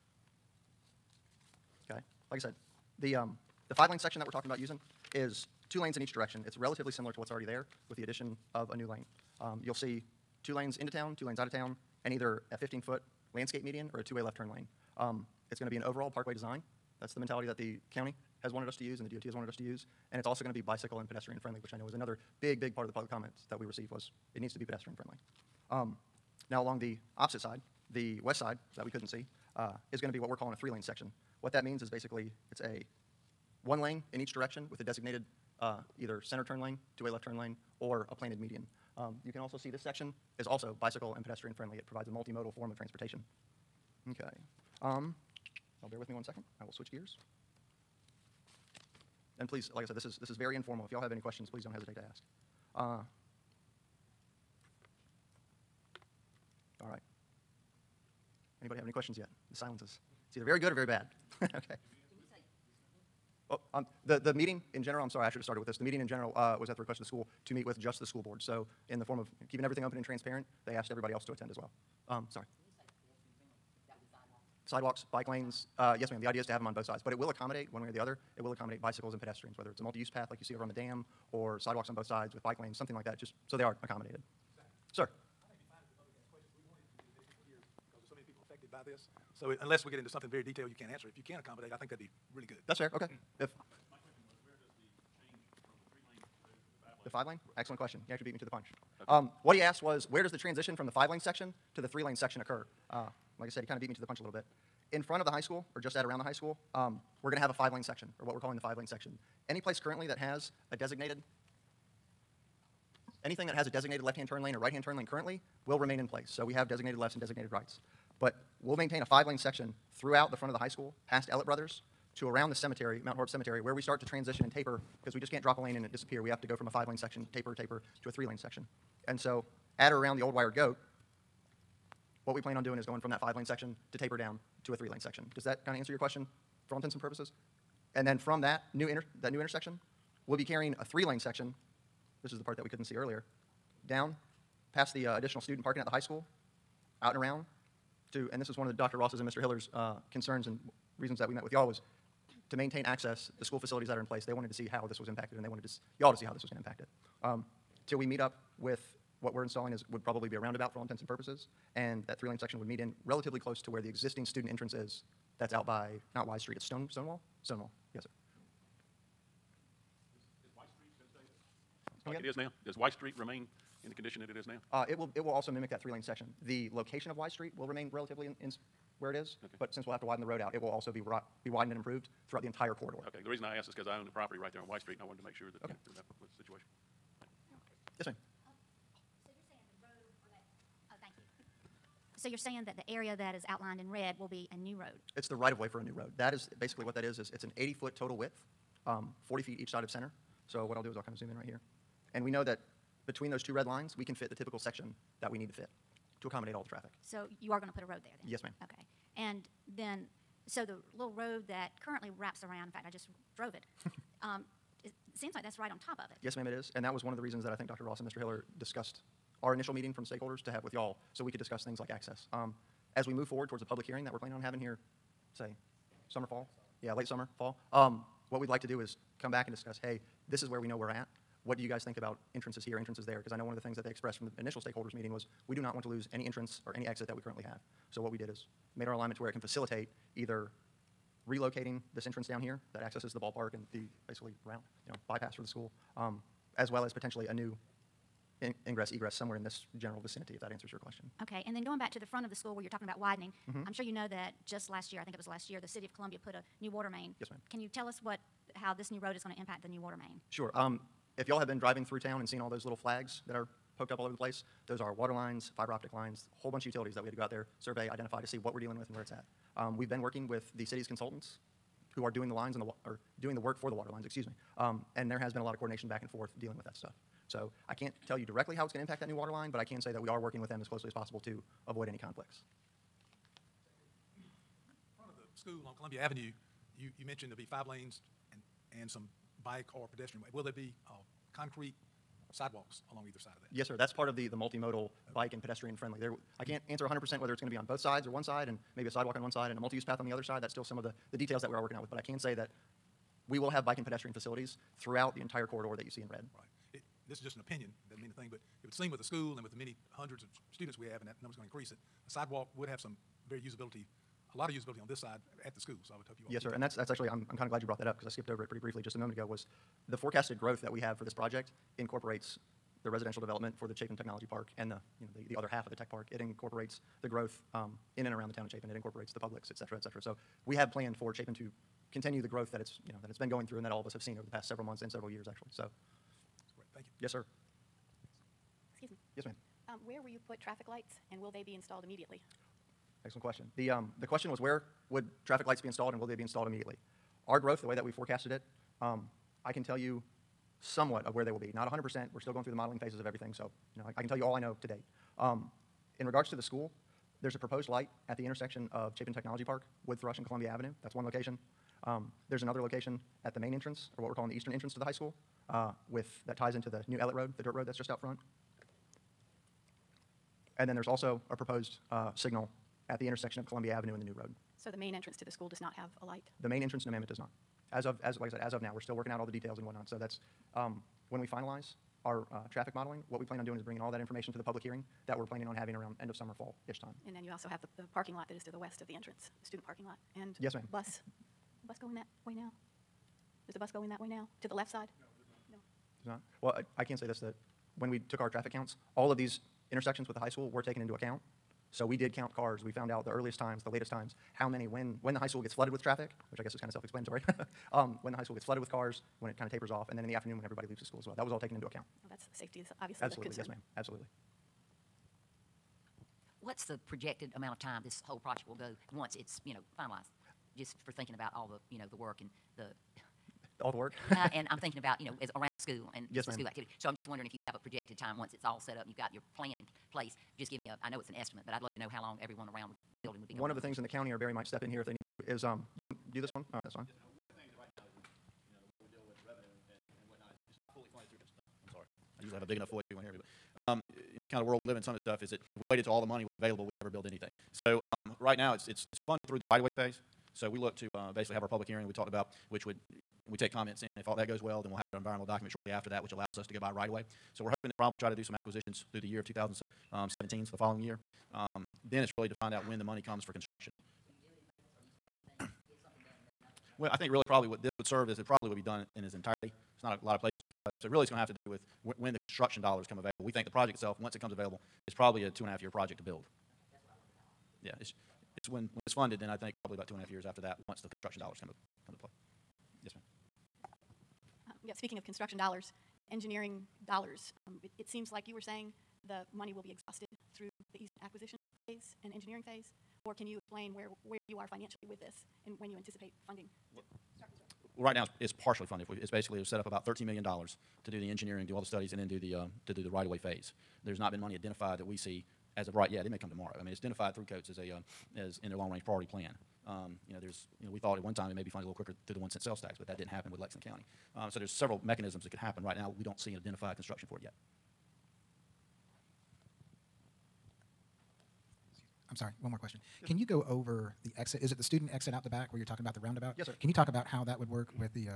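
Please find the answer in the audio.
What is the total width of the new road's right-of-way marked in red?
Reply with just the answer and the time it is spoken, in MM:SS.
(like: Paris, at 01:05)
80 feet, at 03:17.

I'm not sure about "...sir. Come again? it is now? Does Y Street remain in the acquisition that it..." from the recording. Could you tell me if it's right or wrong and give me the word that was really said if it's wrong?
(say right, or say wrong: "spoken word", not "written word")
wrong: "condition", not "acquisition".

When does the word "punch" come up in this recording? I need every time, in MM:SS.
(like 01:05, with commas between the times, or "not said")
01:38, 01:44.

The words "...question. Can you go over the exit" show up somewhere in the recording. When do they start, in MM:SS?
08:42.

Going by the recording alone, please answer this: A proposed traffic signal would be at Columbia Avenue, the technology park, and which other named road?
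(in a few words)
Wood Thrush.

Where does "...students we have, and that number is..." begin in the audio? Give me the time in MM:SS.
05:10.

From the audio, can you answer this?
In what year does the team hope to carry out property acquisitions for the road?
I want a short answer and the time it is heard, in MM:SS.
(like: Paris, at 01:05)
2017, at 07:39.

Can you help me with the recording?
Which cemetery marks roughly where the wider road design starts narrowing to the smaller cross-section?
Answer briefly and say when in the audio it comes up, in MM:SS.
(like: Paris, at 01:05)
Mount Horeb Cemetery, at 02:03.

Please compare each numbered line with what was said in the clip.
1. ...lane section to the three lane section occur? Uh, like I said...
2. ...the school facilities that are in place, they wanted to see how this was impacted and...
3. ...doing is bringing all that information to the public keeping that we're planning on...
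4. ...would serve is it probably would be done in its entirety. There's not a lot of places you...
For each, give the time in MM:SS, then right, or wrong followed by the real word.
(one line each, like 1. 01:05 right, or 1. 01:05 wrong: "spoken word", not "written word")
1. 01:41 right
2. 02:33 right
3. 06:23 wrong: "hearing", not "keeping"
4. 07:47 right.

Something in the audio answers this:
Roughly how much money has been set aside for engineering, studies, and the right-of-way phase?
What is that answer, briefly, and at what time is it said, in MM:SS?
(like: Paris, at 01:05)
$13 million, at 08:19.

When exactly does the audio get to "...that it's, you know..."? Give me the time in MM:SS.
05:32.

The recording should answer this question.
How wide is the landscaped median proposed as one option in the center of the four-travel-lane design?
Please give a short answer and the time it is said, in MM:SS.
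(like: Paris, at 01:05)
15 feet, at 00:12.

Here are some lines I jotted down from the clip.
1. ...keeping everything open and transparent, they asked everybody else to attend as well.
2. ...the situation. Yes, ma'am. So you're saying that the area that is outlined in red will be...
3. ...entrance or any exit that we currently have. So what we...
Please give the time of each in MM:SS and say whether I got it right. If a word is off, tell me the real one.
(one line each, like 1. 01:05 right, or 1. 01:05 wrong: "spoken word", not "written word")
1. 01:09 right
2. 03:06 right
3. 03:56 right.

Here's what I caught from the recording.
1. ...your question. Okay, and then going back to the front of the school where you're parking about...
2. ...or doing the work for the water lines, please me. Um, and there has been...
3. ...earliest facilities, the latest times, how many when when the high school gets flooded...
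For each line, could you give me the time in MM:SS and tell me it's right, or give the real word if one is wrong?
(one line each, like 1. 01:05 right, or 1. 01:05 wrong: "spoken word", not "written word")
1. 04:10 wrong: "talking", not "parking"
2. 04:32 wrong: "excuse", not "please"
3. 06:43 wrong: "times", not "facilities".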